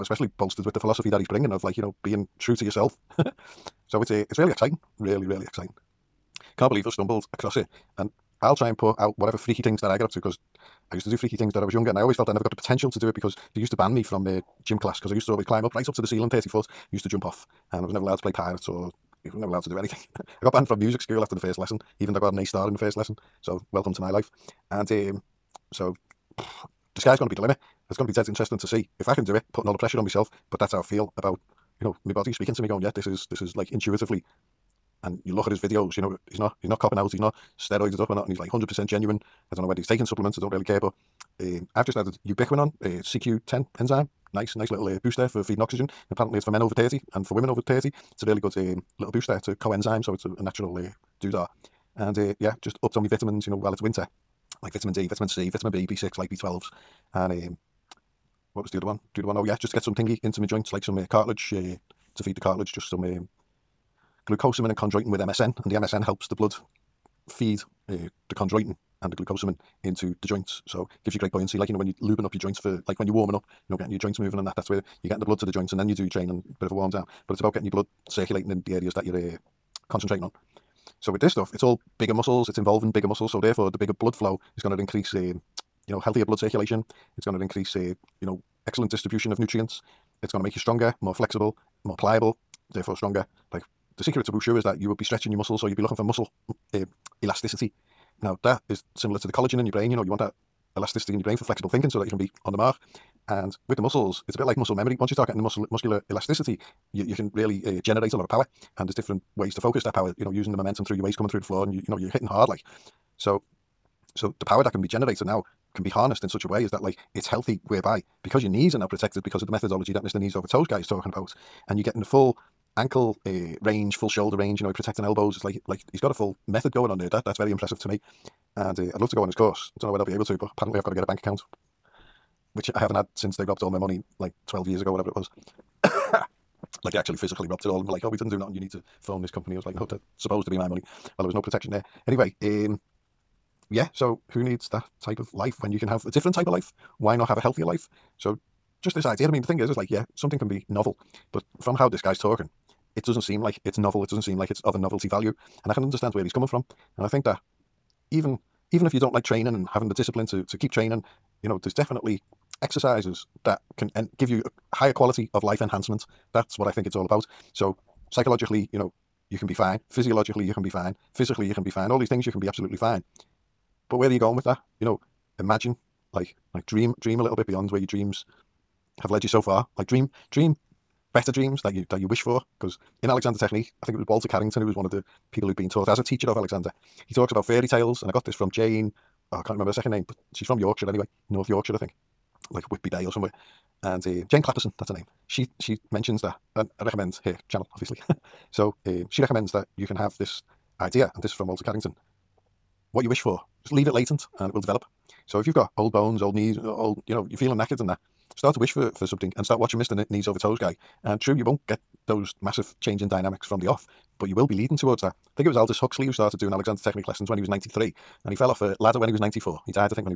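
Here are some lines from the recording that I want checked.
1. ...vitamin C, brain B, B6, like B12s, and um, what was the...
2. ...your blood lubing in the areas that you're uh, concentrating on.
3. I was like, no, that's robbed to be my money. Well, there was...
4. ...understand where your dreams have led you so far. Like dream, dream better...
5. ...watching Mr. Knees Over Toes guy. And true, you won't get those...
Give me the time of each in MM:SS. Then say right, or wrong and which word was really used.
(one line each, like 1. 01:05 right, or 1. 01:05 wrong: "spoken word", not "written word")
1. 00:55 wrong: "vitamin", not "brain"
2. 01:17 wrong: "circulating", not "lubing"
3. 02:19 wrong: "supposed", not "robbed"
4. 02:57 wrong: "beyond", not "understand"
5. 03:29 right.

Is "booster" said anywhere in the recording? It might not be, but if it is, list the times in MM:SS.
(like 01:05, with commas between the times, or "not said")
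00:45, 00:49.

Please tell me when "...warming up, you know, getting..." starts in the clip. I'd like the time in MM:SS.
01:13.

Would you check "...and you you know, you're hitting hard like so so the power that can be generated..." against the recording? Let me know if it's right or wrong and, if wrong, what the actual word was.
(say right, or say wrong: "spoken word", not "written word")
right.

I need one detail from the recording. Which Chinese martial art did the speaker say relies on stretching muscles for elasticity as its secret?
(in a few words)
wushu.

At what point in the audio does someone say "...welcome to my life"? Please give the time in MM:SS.
00:23.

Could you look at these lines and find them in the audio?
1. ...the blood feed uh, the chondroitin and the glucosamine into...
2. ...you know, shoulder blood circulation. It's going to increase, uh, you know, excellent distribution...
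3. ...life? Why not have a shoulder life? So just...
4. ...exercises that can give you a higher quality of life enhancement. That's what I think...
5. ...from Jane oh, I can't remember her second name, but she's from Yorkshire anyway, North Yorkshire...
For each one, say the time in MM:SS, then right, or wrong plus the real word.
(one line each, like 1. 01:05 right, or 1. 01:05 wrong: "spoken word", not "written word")
1. 01:06 right
2. 01:25 wrong: "healthier", not "shoulder"
3. 02:26 wrong: "healthier", not "shoulder"
4. 02:42 right
5. 03:08 right.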